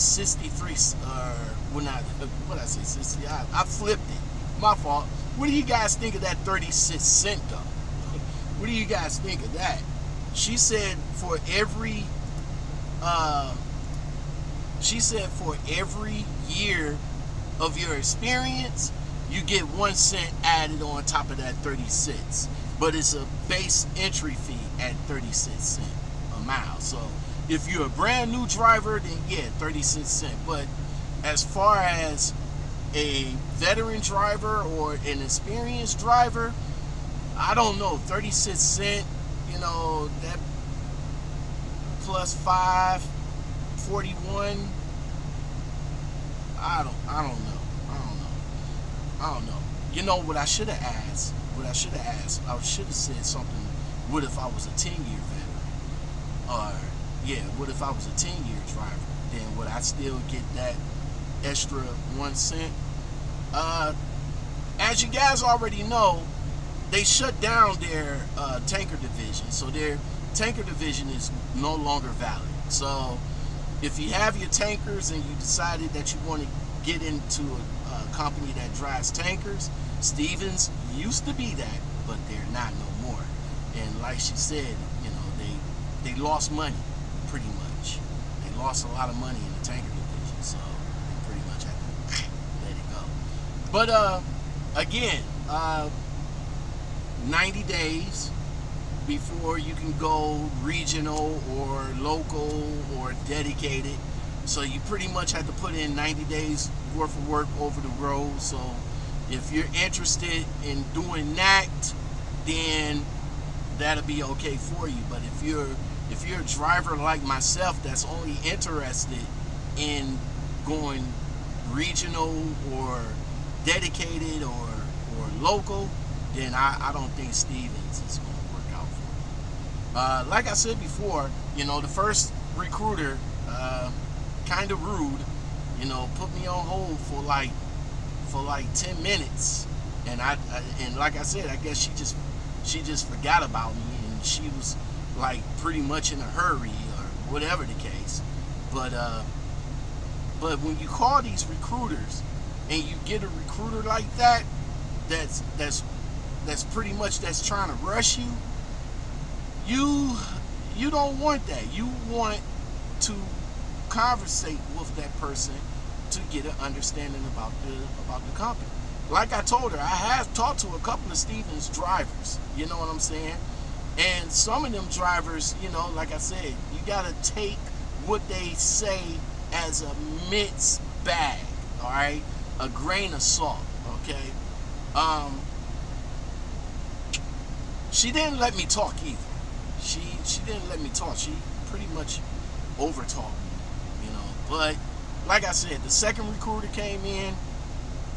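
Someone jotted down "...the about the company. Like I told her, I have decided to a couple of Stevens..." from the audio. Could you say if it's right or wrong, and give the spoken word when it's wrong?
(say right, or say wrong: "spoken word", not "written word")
wrong: "talked", not "decided".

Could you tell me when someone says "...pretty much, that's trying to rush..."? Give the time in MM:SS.
02:36.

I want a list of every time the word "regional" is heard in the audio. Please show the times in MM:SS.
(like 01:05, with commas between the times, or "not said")
01:40, 02:01.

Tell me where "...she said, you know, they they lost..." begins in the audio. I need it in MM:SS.
01:24.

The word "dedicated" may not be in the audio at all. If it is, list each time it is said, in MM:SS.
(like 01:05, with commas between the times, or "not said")
01:43, 02:03.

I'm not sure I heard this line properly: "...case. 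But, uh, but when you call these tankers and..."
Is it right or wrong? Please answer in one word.
wrong.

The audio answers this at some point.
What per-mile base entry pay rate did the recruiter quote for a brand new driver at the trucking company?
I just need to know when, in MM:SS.
00:25.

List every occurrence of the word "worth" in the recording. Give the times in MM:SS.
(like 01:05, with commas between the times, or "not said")
01:46.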